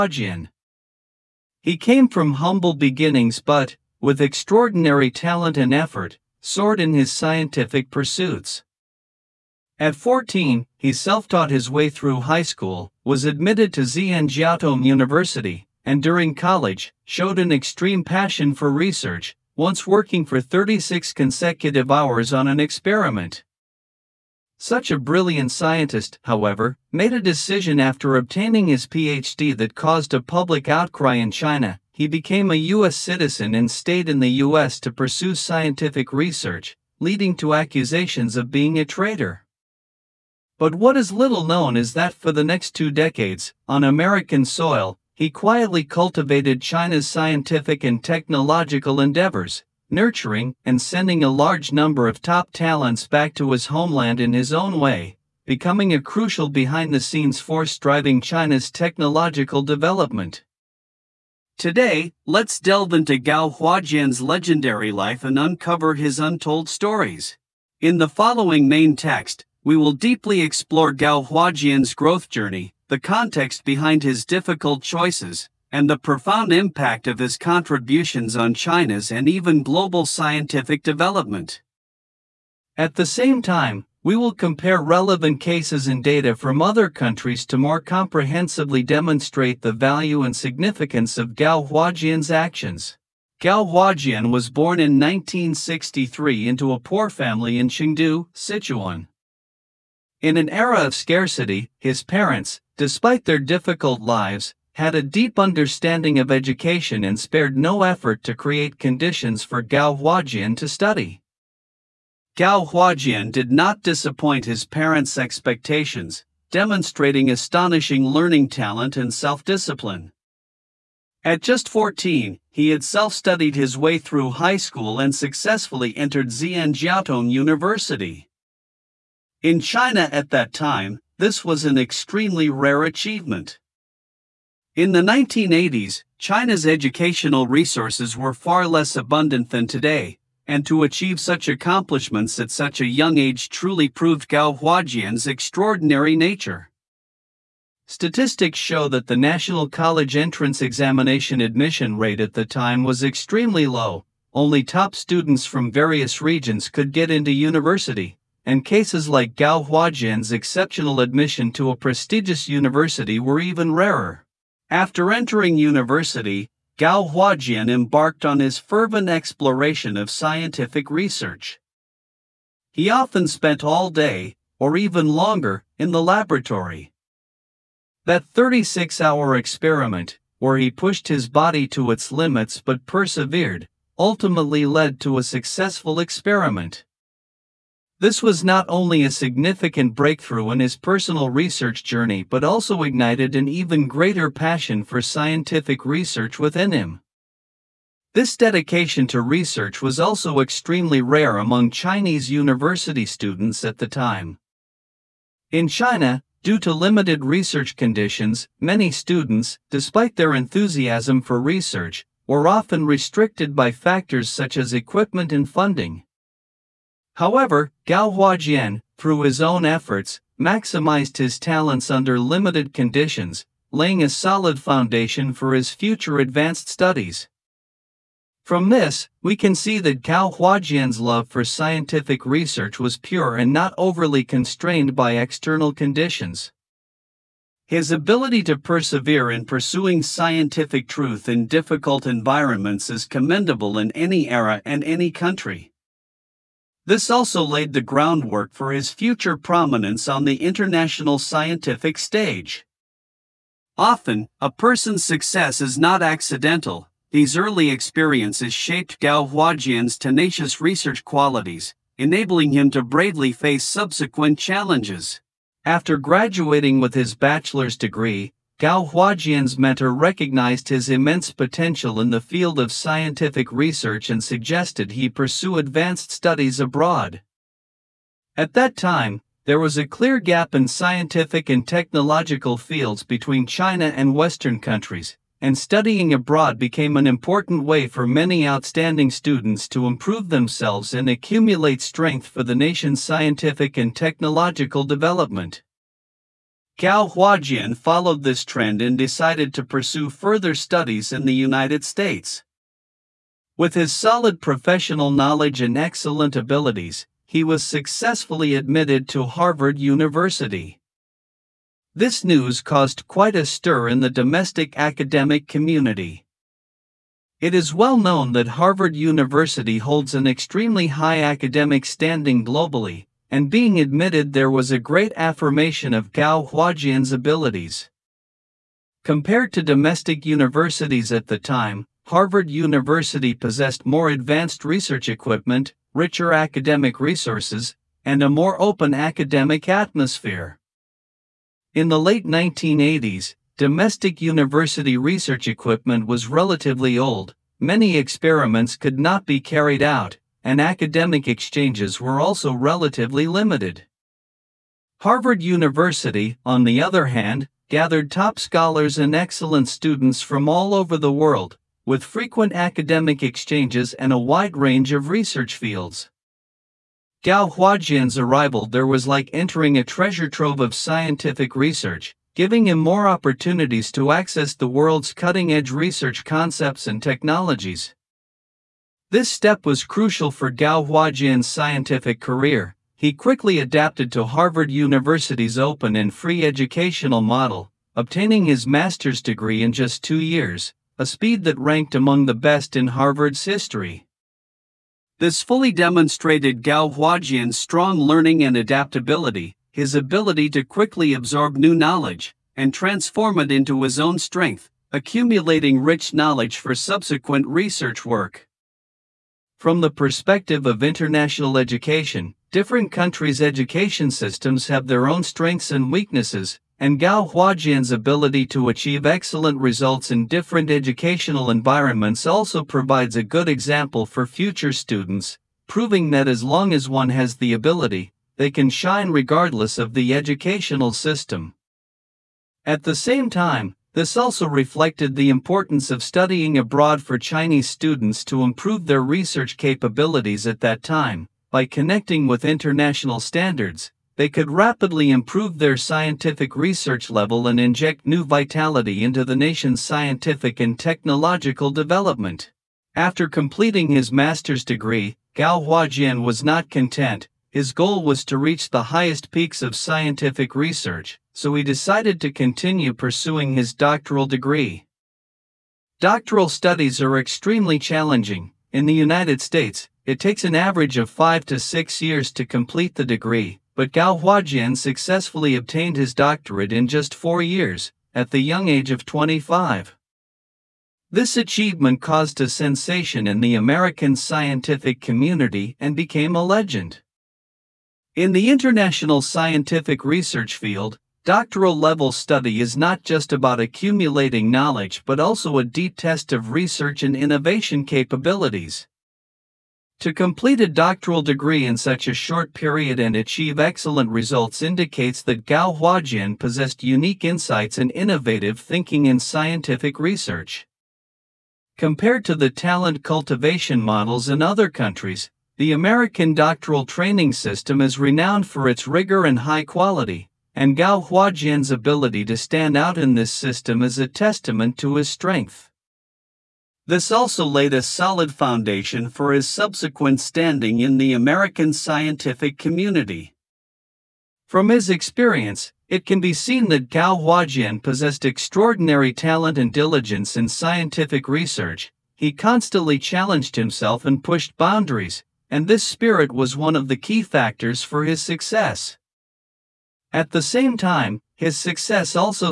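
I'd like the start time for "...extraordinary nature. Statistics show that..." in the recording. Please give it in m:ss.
2:25.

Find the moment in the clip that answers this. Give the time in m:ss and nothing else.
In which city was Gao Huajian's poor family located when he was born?
1:37.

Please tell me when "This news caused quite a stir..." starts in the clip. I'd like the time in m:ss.
5:11.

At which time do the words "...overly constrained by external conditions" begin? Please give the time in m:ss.
3:53.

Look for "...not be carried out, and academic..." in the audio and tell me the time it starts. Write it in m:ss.
5:48.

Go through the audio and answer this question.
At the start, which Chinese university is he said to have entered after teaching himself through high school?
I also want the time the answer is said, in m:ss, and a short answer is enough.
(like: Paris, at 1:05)
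Zhejiang University, at 0:13.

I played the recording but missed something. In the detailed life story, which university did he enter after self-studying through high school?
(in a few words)
Xi'an Jiaotong University.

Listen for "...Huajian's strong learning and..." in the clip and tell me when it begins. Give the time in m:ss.
6:36.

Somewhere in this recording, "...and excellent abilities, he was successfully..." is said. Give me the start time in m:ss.
5:05.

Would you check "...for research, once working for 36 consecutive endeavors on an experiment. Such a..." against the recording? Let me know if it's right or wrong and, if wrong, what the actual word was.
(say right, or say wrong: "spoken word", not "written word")
wrong: "hours", not "endeavors".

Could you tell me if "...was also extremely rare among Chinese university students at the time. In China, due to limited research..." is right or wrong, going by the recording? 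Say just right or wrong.
right.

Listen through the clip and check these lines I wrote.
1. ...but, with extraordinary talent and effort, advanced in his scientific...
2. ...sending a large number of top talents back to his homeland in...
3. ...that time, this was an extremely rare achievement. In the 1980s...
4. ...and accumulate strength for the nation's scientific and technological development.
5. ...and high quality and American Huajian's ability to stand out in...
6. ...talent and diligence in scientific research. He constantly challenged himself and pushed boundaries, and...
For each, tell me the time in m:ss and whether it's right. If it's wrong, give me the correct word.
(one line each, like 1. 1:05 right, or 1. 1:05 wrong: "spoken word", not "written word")
1. 0:03 wrong: "soared", not "advanced"
2. 0:50 right
3. 2:10 right
4. 4:50 right
5. 8:39 wrong: "Gao", not "American"
6. 8:59 right.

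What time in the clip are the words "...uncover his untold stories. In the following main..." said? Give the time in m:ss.
1:05.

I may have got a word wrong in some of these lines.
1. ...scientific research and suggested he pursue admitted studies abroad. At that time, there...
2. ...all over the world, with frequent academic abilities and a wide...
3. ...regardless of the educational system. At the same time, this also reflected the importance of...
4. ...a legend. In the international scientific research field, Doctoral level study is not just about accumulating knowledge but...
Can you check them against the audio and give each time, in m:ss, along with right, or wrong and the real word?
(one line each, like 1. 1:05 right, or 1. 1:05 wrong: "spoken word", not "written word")
1. 4:32 wrong: "advanced", not "admitted"
2. 6:00 wrong: "exchanges", not "abilities"
3. 7:09 right
4. 8:06 right.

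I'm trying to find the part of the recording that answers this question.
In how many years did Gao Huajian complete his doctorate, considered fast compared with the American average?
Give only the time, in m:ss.
7:57.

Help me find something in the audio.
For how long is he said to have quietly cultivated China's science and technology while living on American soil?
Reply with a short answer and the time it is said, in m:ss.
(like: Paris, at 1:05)
Two decades, at 0:42.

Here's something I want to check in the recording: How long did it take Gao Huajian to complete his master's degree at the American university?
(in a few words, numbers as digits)
2 years.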